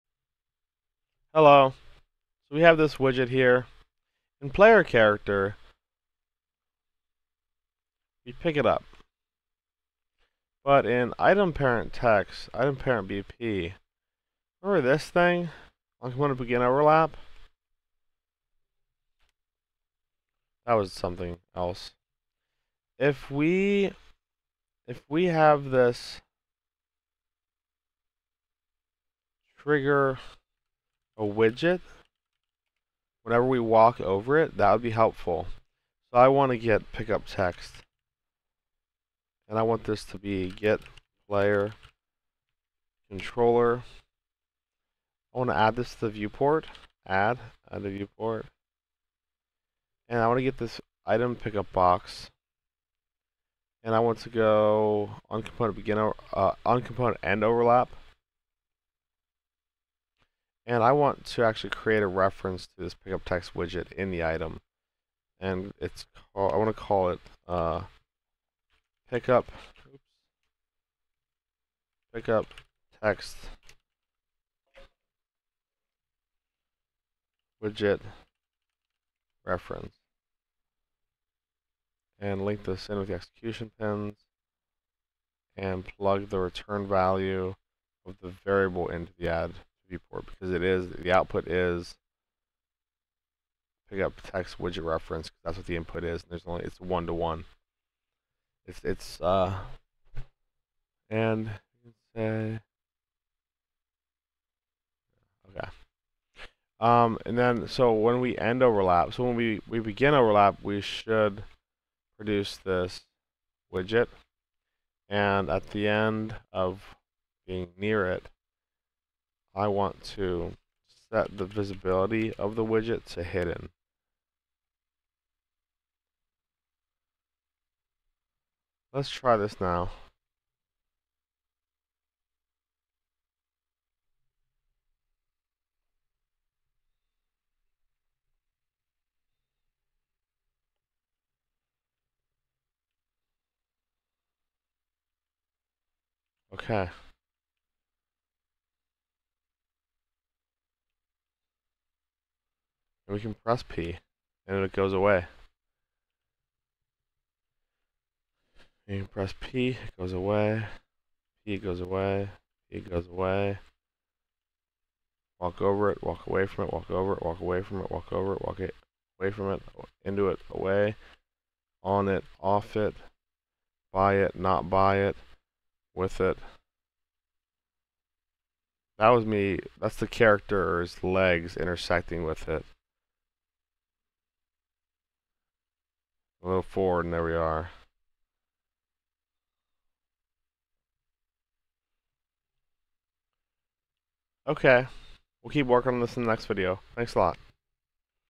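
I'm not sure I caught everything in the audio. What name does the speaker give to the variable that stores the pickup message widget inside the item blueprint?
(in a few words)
Pickup text widget reference.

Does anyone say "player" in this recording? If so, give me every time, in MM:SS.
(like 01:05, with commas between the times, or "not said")
00:04, 00:41.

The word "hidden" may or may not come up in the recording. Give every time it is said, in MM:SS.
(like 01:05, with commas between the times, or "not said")
02:03.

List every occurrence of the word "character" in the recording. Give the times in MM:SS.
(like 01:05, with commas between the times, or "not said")
00:04, 03:00.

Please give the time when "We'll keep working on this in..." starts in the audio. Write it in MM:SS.
03:15.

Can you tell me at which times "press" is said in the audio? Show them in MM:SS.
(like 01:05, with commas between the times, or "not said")
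02:33, 02:39.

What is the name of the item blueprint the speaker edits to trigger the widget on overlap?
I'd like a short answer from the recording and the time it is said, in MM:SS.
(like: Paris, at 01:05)
Item parent BP, at 00:12.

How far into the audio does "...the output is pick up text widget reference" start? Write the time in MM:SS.
01:31.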